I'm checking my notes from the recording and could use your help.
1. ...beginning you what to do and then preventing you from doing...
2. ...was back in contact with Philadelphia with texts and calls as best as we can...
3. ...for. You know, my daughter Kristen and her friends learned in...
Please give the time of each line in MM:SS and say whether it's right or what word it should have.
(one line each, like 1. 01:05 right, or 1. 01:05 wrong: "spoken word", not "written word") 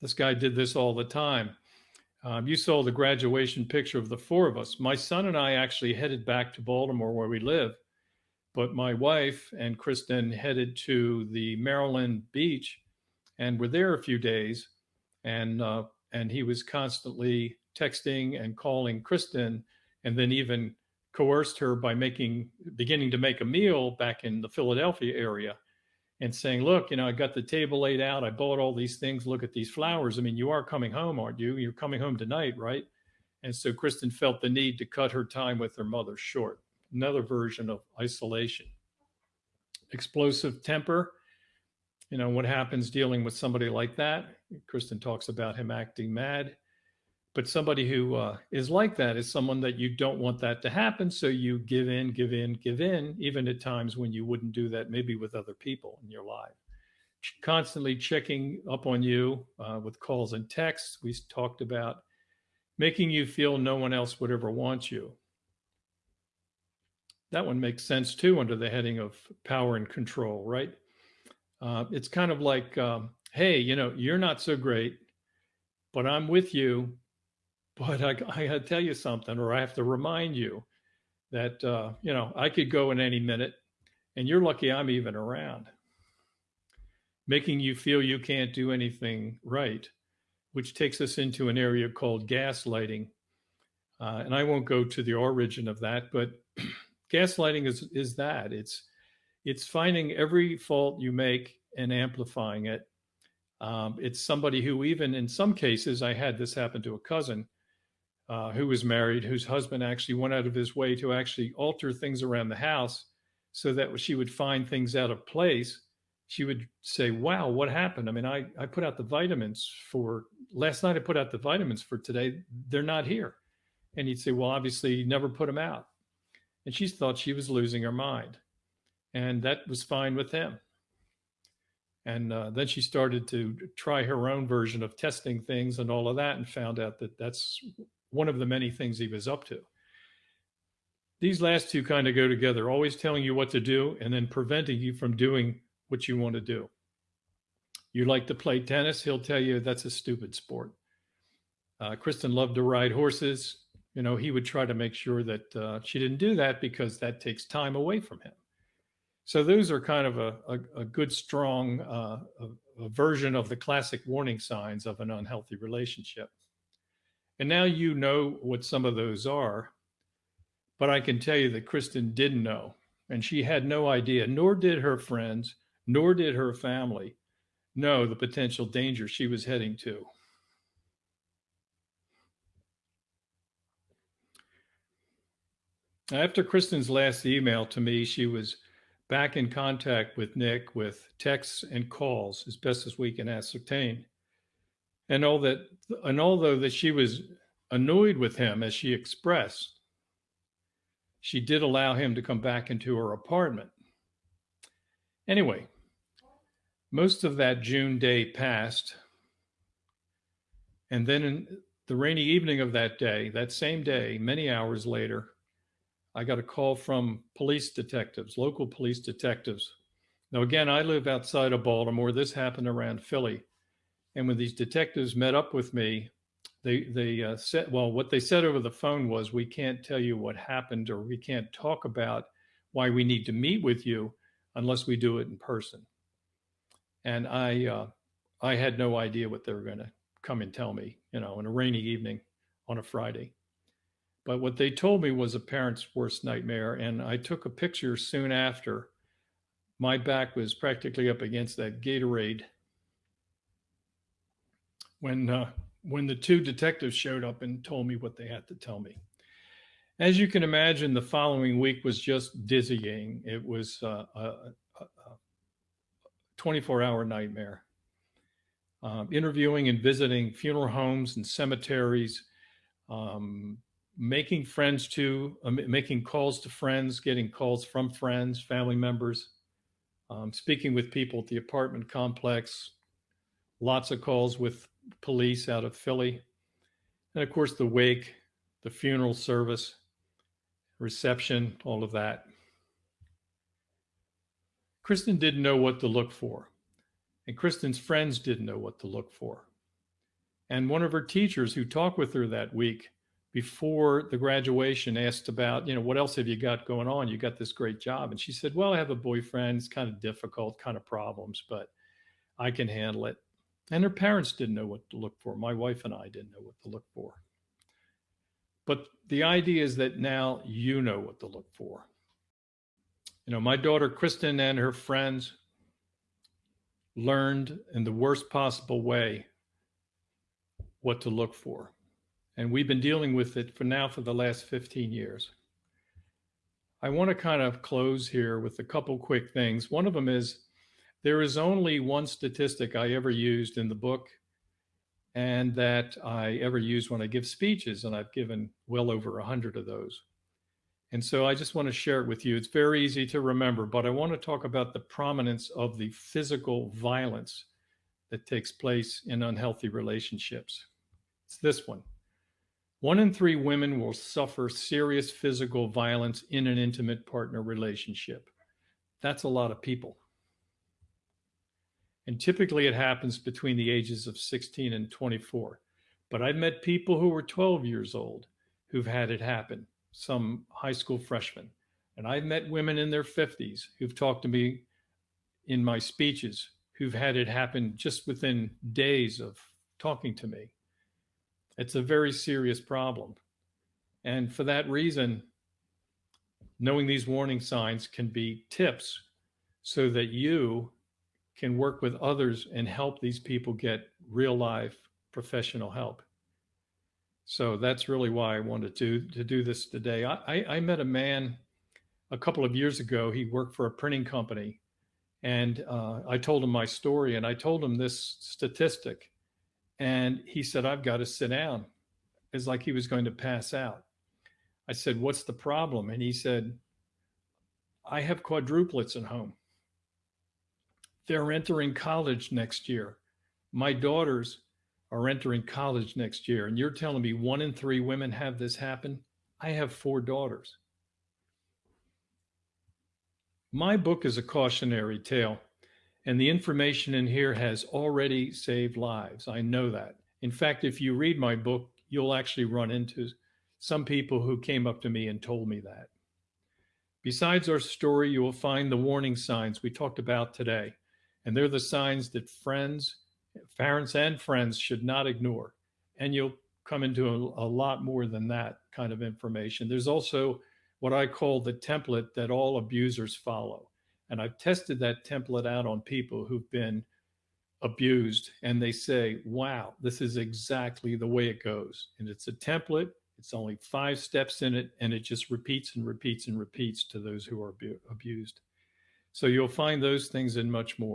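1. 02:22 wrong: "telling", not "beginning"
2. 03:08 wrong: "Nick", not "Philadelphia"
3. 05:21 right.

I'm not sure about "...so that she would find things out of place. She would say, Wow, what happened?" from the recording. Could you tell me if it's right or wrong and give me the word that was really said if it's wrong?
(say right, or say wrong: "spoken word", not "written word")
right.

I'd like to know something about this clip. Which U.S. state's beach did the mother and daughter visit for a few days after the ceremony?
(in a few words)
Maryland.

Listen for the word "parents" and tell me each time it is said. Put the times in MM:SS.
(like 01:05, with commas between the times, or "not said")
04:05, 05:13, 07:43.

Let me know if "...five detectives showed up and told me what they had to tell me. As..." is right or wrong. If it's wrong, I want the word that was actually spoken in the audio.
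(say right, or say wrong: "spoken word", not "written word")
wrong: "two", not "five".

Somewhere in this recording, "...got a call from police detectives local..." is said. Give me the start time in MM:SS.
03:36.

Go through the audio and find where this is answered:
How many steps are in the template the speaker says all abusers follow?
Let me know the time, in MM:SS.
08:03.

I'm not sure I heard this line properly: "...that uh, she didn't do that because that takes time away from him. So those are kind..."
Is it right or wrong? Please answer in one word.
right.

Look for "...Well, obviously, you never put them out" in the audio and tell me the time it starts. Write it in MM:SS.
02:04.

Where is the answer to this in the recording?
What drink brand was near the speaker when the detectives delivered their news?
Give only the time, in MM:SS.
04:11.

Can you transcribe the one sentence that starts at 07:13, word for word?
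My daughters are entering college next year.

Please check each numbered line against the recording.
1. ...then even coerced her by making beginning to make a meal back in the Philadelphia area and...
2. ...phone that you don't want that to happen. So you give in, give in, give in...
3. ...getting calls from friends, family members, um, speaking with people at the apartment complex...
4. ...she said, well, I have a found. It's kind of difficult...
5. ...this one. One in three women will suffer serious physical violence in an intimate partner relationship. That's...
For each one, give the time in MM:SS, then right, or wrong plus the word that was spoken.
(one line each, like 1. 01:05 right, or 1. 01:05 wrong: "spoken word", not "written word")
1. 00:20 right
2. 00:49 wrong: "someone", not "phone"
3. 04:36 right
4. 05:08 wrong: "boyfriend", not "found"
5. 06:01 right.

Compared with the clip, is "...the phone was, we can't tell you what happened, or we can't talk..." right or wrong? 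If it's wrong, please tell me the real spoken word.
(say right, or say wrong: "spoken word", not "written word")
right.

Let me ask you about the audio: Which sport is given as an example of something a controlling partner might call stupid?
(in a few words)
Tennis.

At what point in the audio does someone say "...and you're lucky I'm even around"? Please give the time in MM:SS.
01:24.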